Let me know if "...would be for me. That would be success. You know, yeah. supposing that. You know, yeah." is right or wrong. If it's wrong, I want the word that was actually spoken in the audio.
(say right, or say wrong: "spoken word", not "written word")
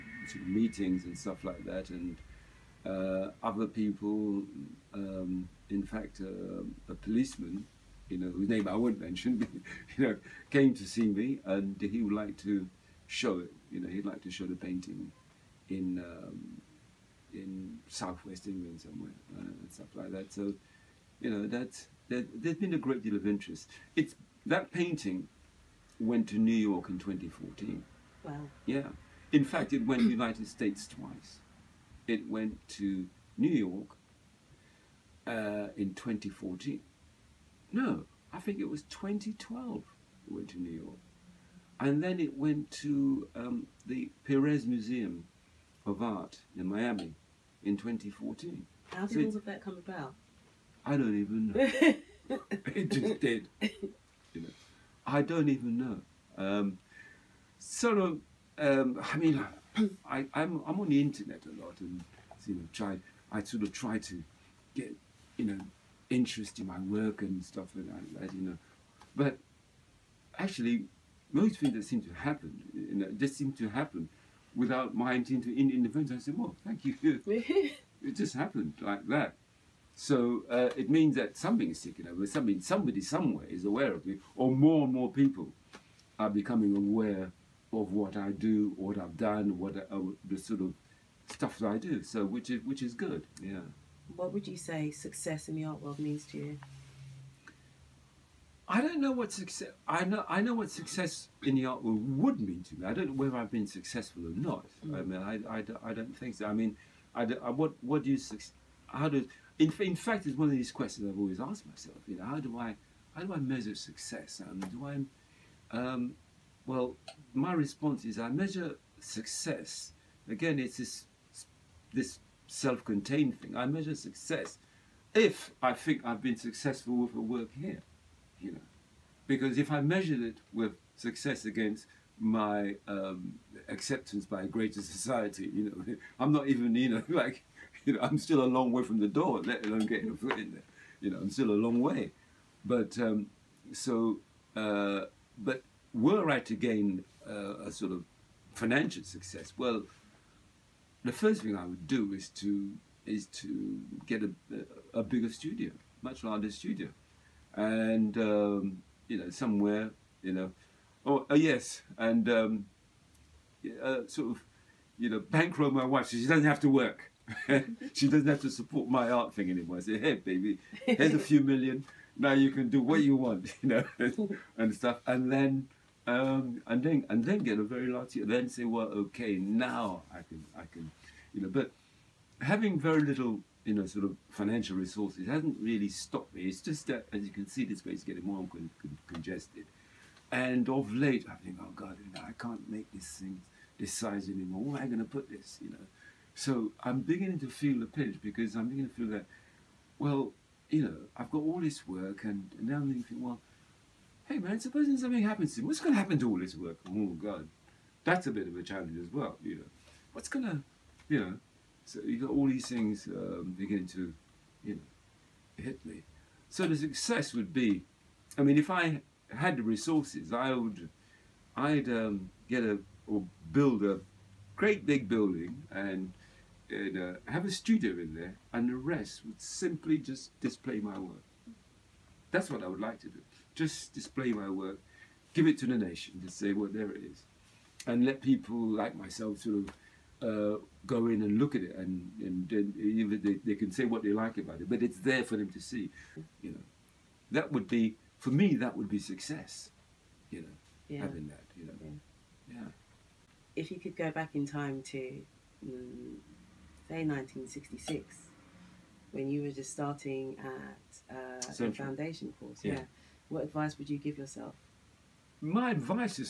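wrong: "having", not "supposing".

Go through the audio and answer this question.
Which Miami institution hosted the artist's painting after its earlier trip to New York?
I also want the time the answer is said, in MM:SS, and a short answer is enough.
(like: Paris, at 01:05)
Perez Museum of Art, at 00:44.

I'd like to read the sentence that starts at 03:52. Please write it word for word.
That's what I would like to do just display my work, give it to the nation and say, well, there it is.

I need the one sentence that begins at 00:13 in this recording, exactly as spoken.
You know, he'd like to show the painting in um, in southwest England somewhere uh, and stuff like that.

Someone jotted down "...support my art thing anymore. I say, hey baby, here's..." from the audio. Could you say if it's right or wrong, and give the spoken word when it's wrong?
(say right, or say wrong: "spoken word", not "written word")
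right.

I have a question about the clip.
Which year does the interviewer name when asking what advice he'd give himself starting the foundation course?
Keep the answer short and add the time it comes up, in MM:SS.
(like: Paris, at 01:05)
1966, at 04:17.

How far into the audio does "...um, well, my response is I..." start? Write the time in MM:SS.
01:55.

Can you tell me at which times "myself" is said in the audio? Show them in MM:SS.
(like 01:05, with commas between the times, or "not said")
01:51, 03:58.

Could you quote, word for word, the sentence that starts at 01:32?
So which is which is good.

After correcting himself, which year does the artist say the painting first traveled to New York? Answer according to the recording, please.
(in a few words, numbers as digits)
2012.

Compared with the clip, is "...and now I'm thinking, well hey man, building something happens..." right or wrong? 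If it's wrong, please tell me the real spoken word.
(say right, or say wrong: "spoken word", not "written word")
wrong: "supposing", not "building".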